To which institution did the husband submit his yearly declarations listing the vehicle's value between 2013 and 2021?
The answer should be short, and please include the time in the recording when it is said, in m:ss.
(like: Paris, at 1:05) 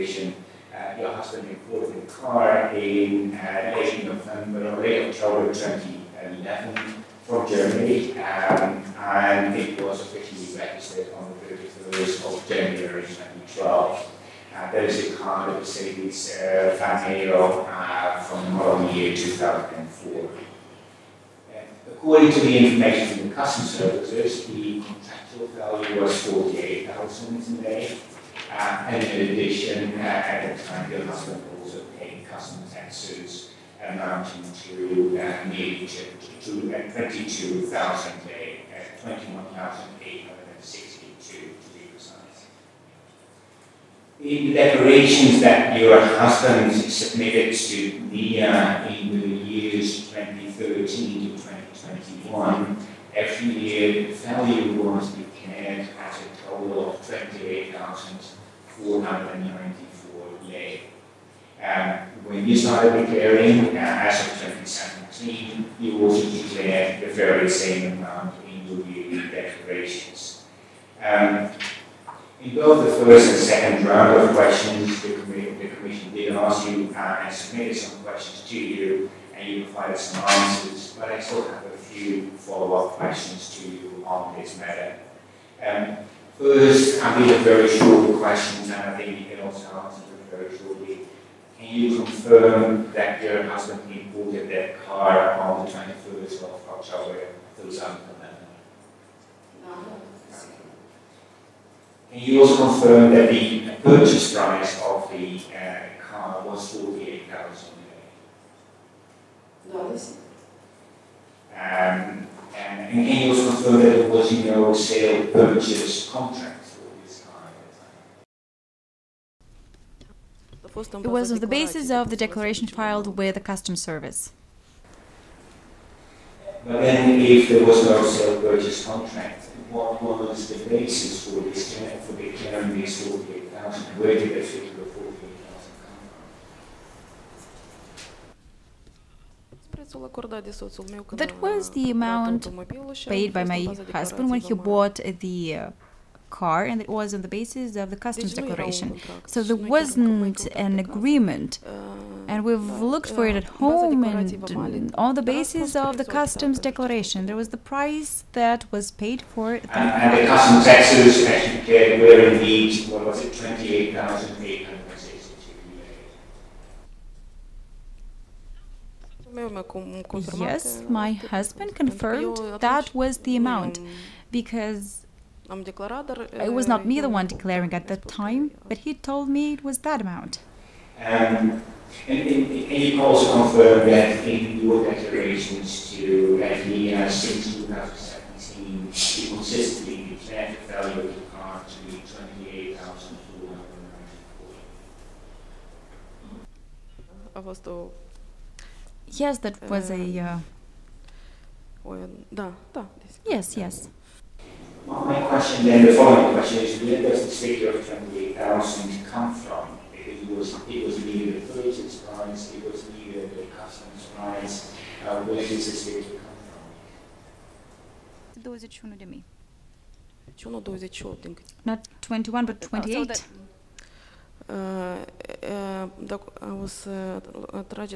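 NIA, at 0:48.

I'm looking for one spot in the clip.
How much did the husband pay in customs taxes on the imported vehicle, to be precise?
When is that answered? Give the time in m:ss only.
0:36.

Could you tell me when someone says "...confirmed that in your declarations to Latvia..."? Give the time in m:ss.
3:03.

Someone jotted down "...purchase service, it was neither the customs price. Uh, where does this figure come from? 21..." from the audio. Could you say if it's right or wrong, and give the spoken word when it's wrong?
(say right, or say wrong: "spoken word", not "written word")
wrong: "price", not "service".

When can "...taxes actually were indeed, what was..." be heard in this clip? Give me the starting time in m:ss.
2:40.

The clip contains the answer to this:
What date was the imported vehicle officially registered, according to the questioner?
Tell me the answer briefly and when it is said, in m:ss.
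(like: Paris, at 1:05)
31 January 2012, at 0:11.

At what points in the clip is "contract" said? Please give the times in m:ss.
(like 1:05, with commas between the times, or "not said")
1:56, 2:08.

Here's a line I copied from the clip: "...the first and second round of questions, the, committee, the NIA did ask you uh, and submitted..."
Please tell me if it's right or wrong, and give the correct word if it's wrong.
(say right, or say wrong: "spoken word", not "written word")
wrong: "Commission", not "NIA".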